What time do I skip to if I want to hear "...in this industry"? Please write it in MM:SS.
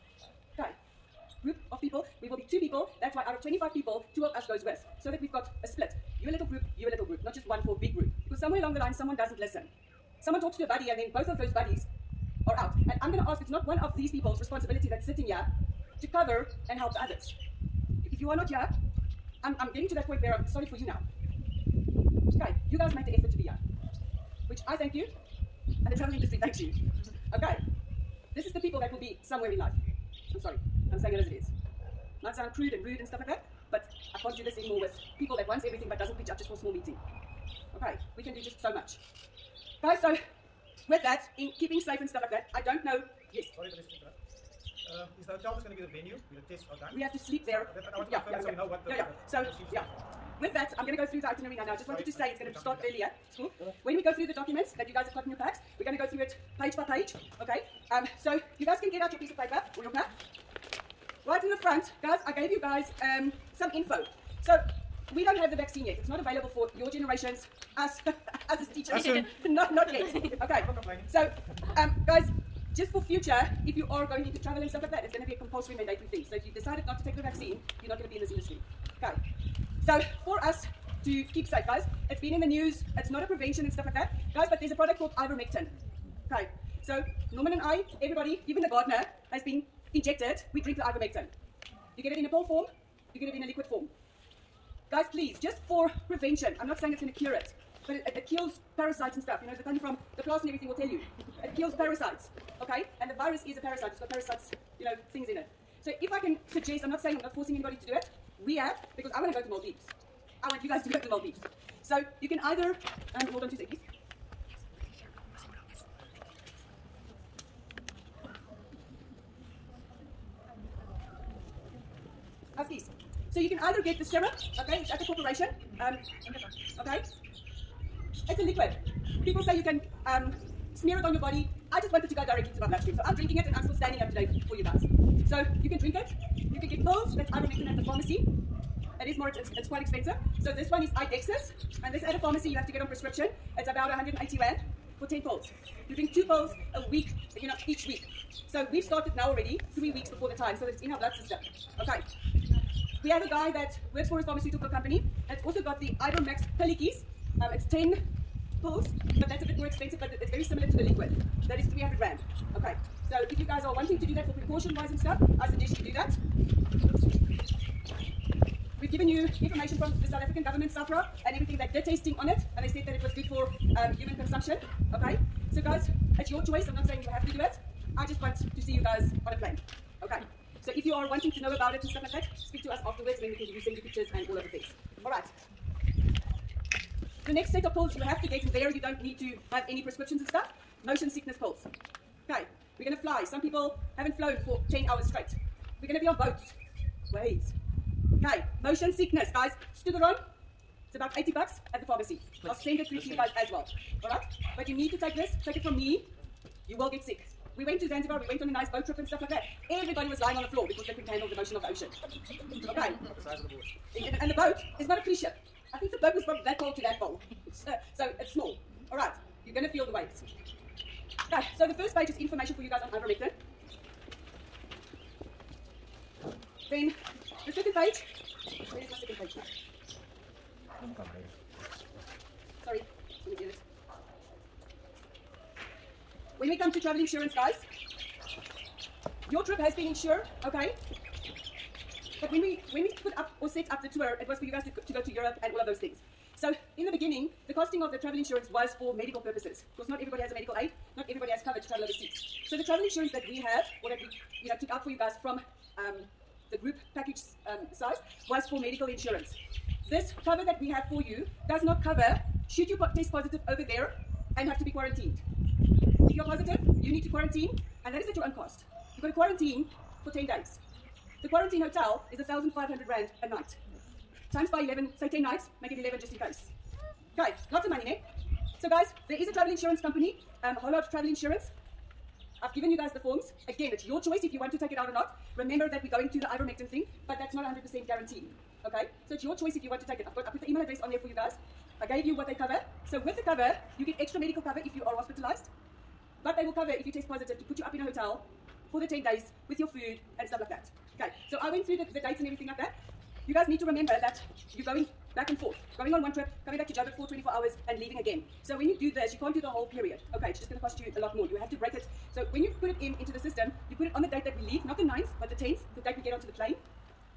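01:18.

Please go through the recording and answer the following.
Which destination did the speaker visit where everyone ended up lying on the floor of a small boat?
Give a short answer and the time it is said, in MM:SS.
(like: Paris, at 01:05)
Zanzibar, at 03:27.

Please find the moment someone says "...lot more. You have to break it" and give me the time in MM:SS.
05:10.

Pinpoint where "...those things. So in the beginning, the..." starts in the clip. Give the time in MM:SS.
04:05.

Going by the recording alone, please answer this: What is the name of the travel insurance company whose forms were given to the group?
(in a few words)
Hollard.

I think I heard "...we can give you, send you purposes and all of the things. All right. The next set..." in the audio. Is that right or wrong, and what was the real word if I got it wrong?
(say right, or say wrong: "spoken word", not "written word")
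wrong: "pictures", not "purposes".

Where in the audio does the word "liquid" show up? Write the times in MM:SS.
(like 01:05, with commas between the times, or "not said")
01:33, 02:08, 02:40.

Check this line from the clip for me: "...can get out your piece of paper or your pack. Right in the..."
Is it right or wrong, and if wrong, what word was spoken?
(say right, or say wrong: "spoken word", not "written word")
right.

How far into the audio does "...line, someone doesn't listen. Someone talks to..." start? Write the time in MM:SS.
00:08.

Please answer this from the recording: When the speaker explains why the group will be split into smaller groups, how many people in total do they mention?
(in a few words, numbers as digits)
25.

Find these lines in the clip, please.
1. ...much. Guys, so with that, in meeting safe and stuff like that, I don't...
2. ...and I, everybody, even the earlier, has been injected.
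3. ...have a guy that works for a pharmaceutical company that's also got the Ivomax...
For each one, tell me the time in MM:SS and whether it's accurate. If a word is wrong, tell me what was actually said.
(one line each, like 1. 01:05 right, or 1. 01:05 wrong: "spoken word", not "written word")
1. 00:38 wrong: "keeping", not "meeting"
2. 01:27 wrong: "gardener", not "earlier"
3. 02:33 right.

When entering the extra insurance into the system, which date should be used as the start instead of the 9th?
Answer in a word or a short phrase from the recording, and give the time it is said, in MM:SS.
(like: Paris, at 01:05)
the 10th, at 05:15.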